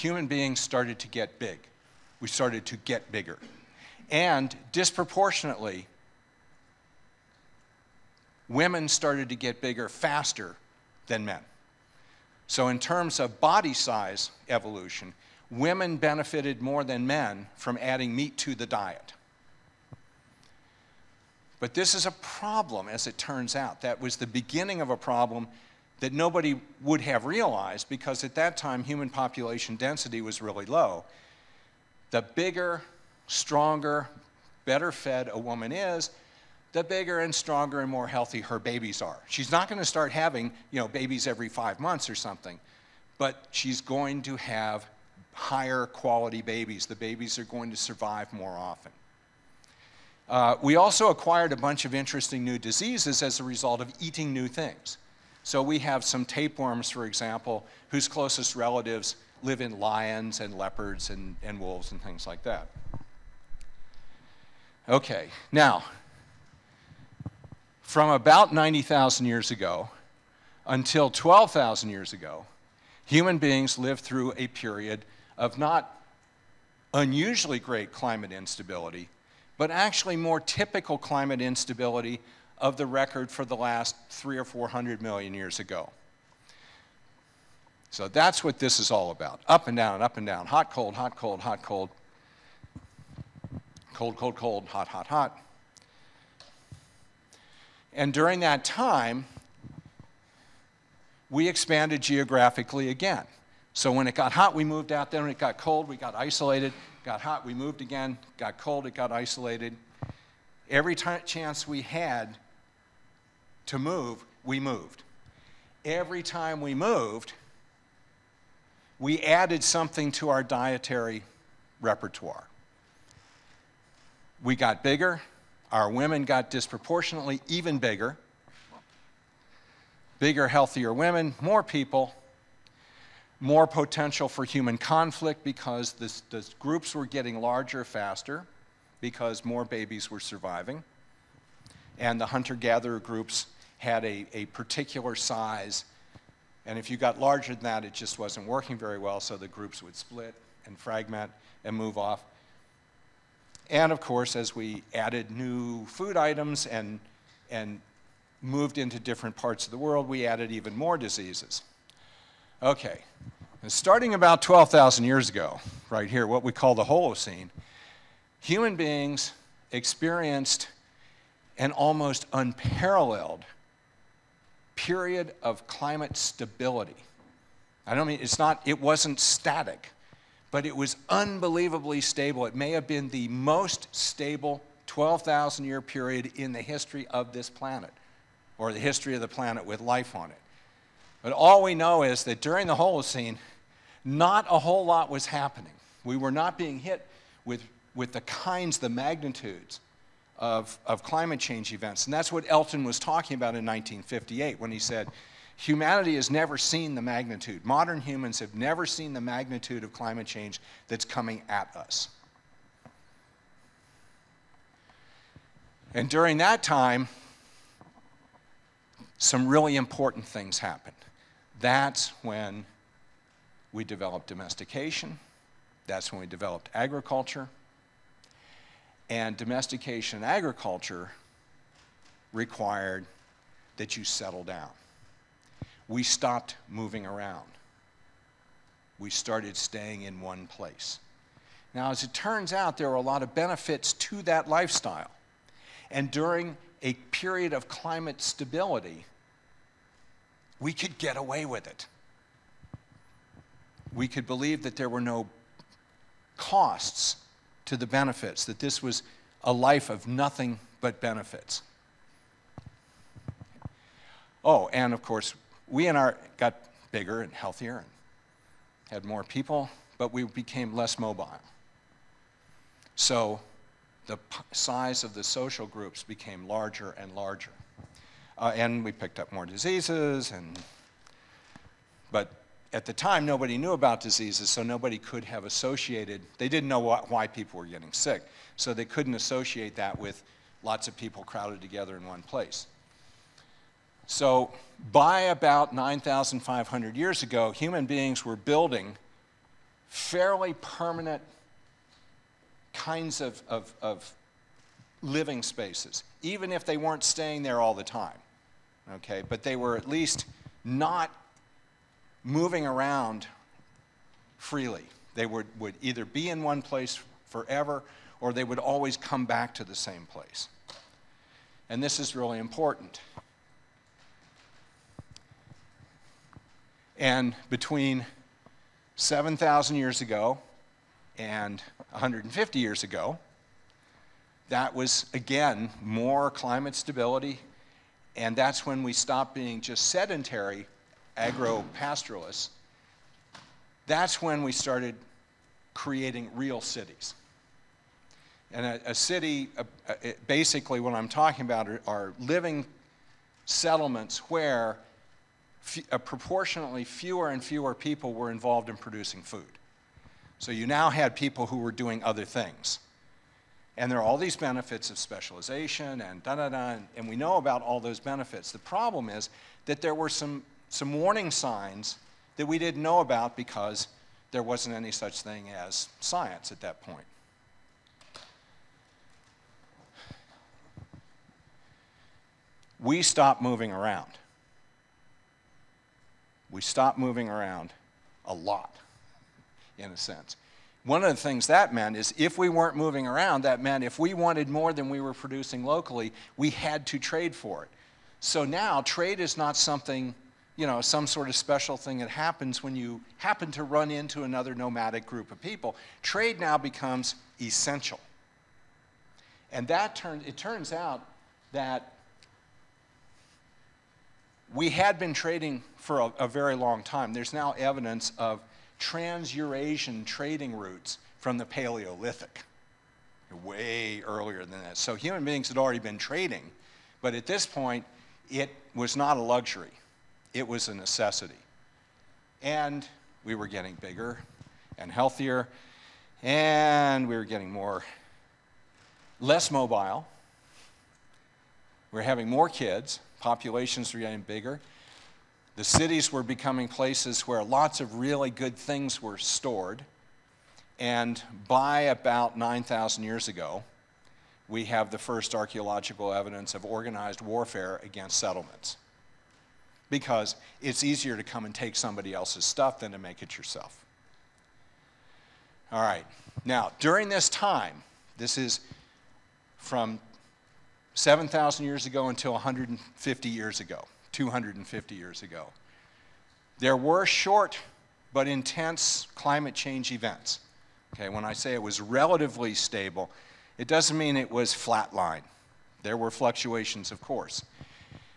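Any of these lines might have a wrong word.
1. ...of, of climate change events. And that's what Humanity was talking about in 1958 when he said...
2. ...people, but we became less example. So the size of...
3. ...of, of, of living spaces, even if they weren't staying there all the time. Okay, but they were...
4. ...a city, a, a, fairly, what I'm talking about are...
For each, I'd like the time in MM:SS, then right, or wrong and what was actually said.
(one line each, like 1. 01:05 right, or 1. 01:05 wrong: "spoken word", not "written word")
1. 03:20 wrong: "Elton", not "Humanity"
2. 04:29 wrong: "mobile", not "example"
3. 05:03 right
4. 05:48 wrong: "basically", not "fairly".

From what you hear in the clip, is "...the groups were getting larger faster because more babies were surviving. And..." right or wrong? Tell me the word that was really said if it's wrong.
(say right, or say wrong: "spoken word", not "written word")
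right.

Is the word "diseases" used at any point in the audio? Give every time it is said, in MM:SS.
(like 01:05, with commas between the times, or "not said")
00:52, 02:40, 04:39, 04:44.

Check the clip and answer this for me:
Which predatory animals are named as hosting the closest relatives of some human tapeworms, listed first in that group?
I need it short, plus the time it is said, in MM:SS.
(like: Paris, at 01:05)
lions, at 00:59.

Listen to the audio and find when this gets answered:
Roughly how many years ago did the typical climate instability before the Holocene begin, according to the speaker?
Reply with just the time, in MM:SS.
01:08.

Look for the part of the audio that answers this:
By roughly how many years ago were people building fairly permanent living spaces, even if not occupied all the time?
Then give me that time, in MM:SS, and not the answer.
04:55.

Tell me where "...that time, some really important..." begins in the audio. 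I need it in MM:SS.
03:36.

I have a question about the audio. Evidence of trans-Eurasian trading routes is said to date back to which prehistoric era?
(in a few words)
Paleolithic.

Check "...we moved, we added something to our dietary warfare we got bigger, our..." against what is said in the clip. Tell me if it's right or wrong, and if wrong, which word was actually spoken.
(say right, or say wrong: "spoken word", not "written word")
wrong: "repertoire", not "warfare".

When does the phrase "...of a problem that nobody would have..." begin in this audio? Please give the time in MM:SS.
00:24.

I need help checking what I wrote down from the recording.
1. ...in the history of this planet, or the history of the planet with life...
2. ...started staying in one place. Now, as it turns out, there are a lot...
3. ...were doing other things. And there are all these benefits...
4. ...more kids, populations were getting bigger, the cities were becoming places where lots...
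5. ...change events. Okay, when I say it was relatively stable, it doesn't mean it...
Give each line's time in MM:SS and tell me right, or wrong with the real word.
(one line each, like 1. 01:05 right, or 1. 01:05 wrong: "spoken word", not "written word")
1. 03:06 right
2. 03:59 right
3. 06:01 right
4. 07:22 right
5. 07:59 right.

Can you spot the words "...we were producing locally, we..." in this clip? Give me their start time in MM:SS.
06:34.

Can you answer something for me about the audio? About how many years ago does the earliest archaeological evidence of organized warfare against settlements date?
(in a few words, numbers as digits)
9,000.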